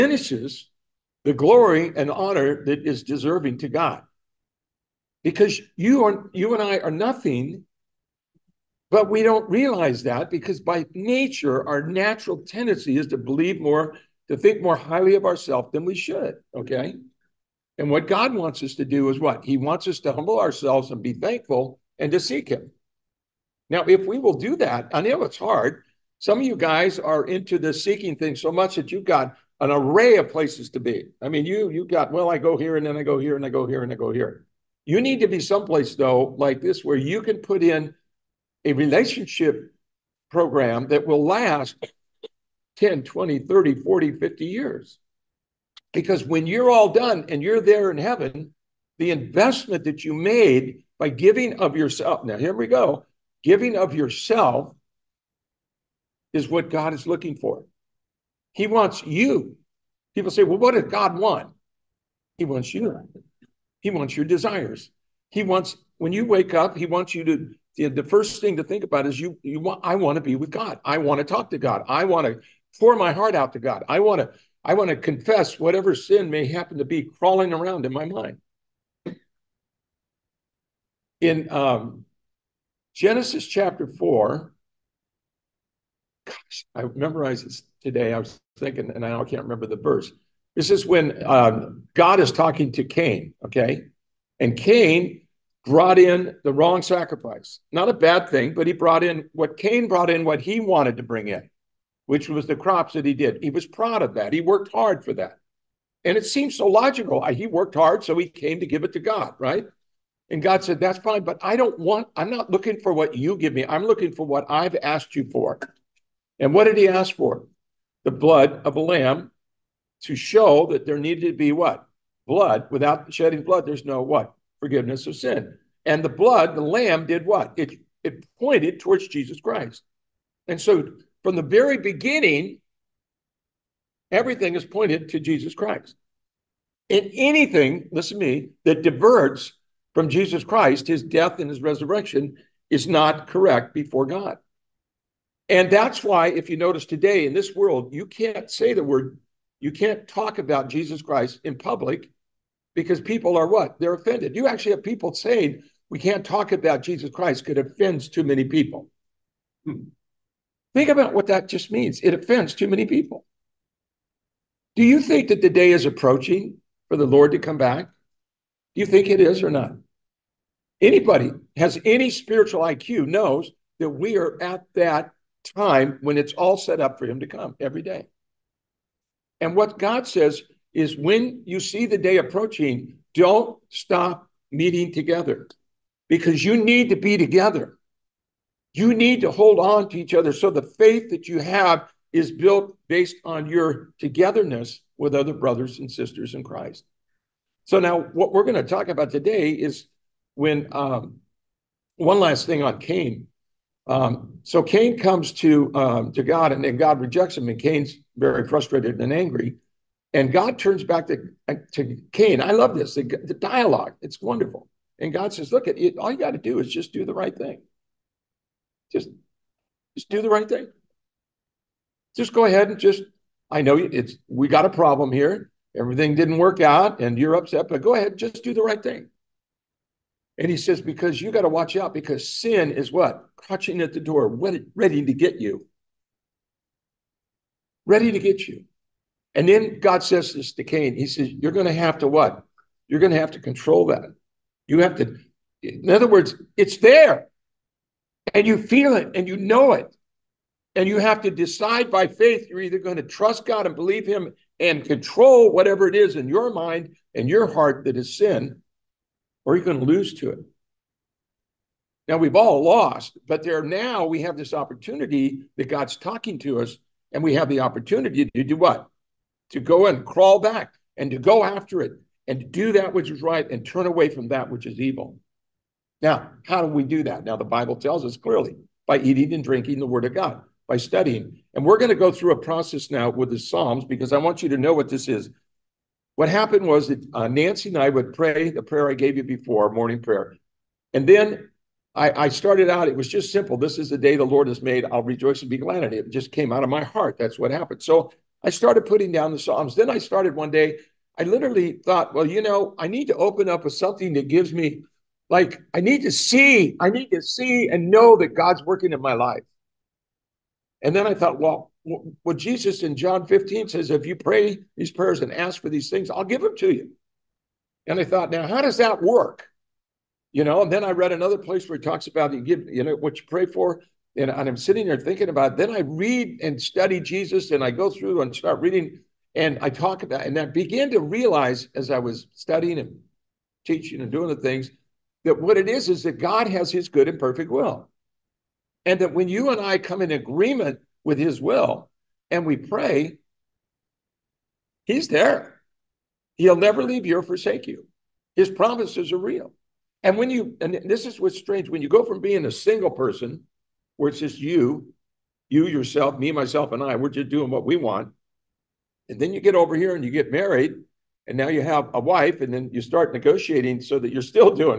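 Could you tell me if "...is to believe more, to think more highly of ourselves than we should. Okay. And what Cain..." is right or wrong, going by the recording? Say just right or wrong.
wrong.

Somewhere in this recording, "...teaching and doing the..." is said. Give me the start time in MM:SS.
05:33.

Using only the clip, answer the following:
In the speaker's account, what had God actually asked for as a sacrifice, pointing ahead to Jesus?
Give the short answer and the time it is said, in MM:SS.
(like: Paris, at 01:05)
The blood of a lamb, at 01:58.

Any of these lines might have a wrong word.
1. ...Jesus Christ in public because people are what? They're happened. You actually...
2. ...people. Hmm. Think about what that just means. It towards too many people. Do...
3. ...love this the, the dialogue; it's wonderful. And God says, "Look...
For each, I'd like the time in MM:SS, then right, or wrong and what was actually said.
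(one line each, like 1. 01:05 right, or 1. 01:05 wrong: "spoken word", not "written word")
1. 02:30 wrong: "offended", not "happened"
2. 02:38 wrong: "offends", not "towards"
3. 03:32 right.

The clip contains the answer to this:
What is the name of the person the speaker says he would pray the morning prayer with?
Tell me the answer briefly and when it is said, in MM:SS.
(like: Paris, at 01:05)
Nancy, at 04:47.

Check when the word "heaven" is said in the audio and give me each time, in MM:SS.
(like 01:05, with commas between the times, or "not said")
00:47.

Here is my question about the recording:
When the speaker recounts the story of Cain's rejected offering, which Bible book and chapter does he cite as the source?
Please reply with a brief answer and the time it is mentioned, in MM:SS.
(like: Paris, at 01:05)
Genesis chapter 4, at 01:22.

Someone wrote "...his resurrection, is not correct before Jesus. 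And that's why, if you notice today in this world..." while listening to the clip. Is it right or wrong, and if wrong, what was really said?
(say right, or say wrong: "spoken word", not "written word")
wrong: "God", not "Jesus".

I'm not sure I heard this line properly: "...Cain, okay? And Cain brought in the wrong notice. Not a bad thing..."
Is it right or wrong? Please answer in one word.
wrong.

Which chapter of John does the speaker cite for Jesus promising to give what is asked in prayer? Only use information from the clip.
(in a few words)
John 15.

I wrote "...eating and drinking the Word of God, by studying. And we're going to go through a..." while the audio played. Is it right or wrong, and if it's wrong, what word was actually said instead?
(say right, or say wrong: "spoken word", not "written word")
right.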